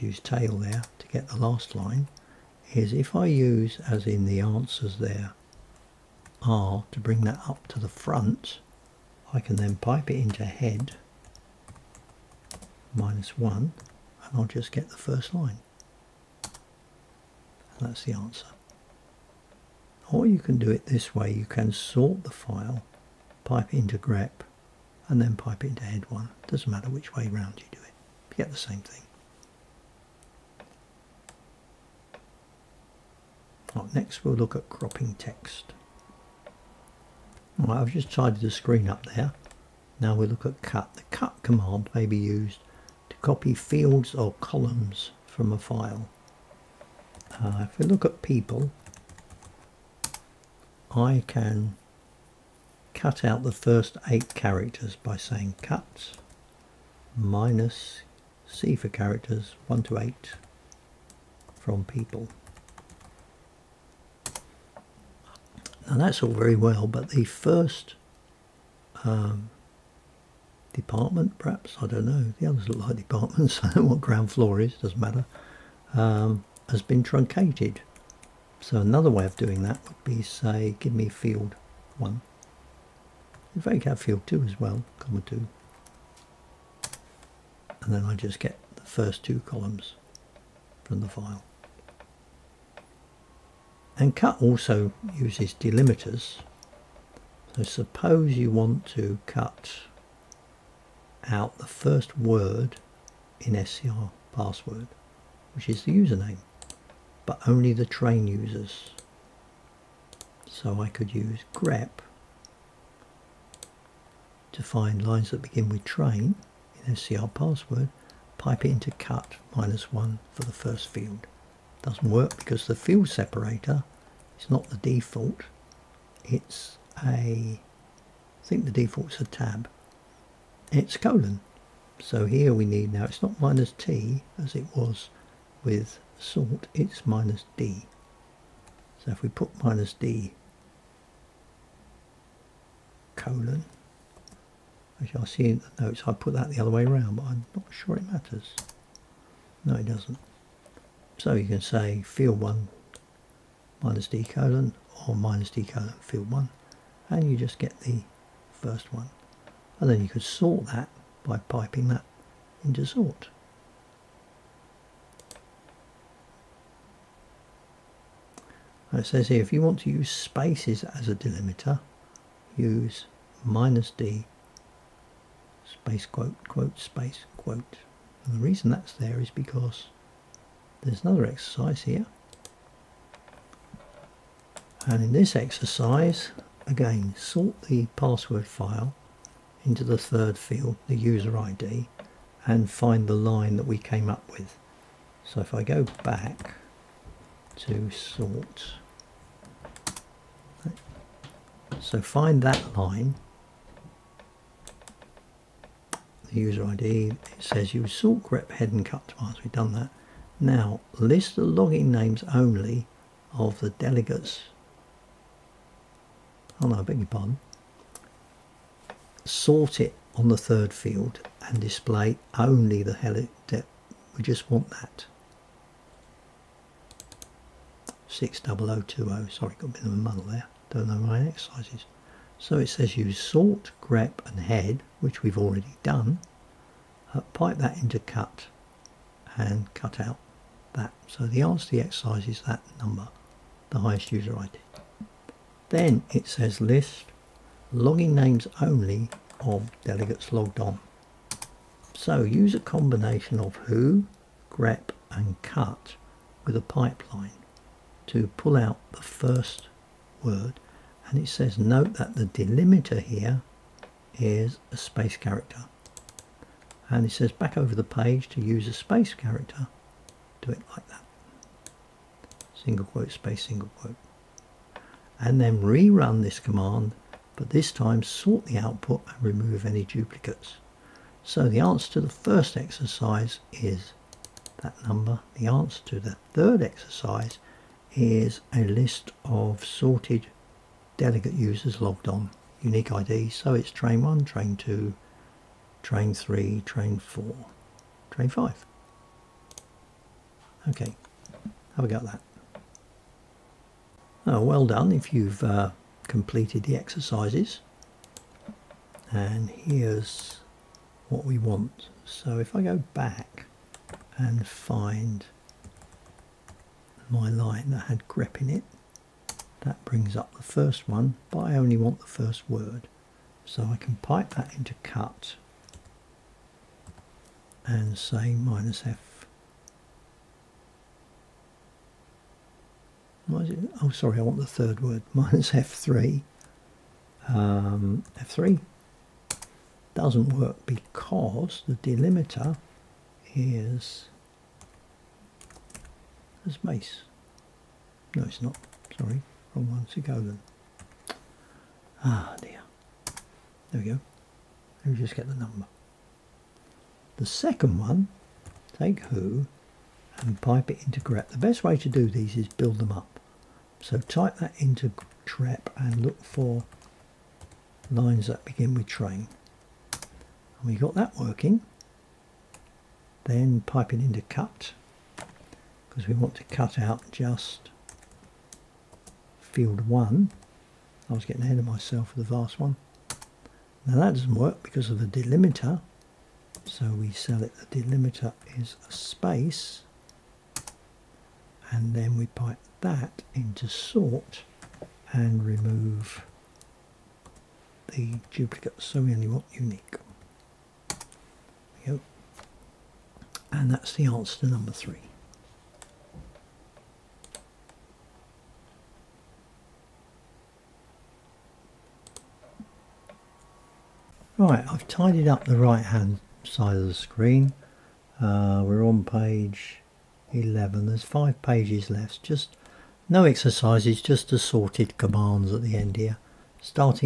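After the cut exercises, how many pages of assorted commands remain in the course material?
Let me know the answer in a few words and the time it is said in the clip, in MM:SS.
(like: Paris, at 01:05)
5, at 07:01.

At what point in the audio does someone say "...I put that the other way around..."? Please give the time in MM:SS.
02:26.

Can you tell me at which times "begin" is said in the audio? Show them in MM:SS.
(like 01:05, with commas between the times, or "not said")
01:55, 06:08.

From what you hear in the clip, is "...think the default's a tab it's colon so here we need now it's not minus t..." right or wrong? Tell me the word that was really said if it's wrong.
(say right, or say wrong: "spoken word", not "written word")
right.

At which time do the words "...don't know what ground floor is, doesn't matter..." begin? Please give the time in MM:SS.
01:13.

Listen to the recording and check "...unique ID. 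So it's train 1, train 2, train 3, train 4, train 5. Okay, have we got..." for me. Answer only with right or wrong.
right.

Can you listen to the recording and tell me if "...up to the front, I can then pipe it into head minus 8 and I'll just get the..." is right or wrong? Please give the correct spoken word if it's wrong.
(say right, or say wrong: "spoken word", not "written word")
wrong: "1", not "8".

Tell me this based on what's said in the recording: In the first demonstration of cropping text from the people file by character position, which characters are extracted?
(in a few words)
1 to 8.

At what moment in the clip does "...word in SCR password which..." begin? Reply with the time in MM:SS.
01:42.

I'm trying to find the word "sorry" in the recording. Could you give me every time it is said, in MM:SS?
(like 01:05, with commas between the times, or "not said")
03:49, 05:33, 05:48.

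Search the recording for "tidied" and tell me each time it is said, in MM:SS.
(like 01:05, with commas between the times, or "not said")
00:38, 06:54.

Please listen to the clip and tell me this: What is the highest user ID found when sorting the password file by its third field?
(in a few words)
60020.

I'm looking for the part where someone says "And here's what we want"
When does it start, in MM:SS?
05:09.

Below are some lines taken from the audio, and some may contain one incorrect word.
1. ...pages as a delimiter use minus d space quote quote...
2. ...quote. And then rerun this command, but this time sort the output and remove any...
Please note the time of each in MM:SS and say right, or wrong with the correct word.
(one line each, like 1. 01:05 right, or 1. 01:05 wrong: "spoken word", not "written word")
1. 02:50 wrong: "spaces", not "pages"
2. 04:33 right.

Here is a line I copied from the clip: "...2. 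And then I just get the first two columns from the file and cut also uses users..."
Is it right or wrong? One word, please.
wrong.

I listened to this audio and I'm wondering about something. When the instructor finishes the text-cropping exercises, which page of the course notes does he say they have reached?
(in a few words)
page 11.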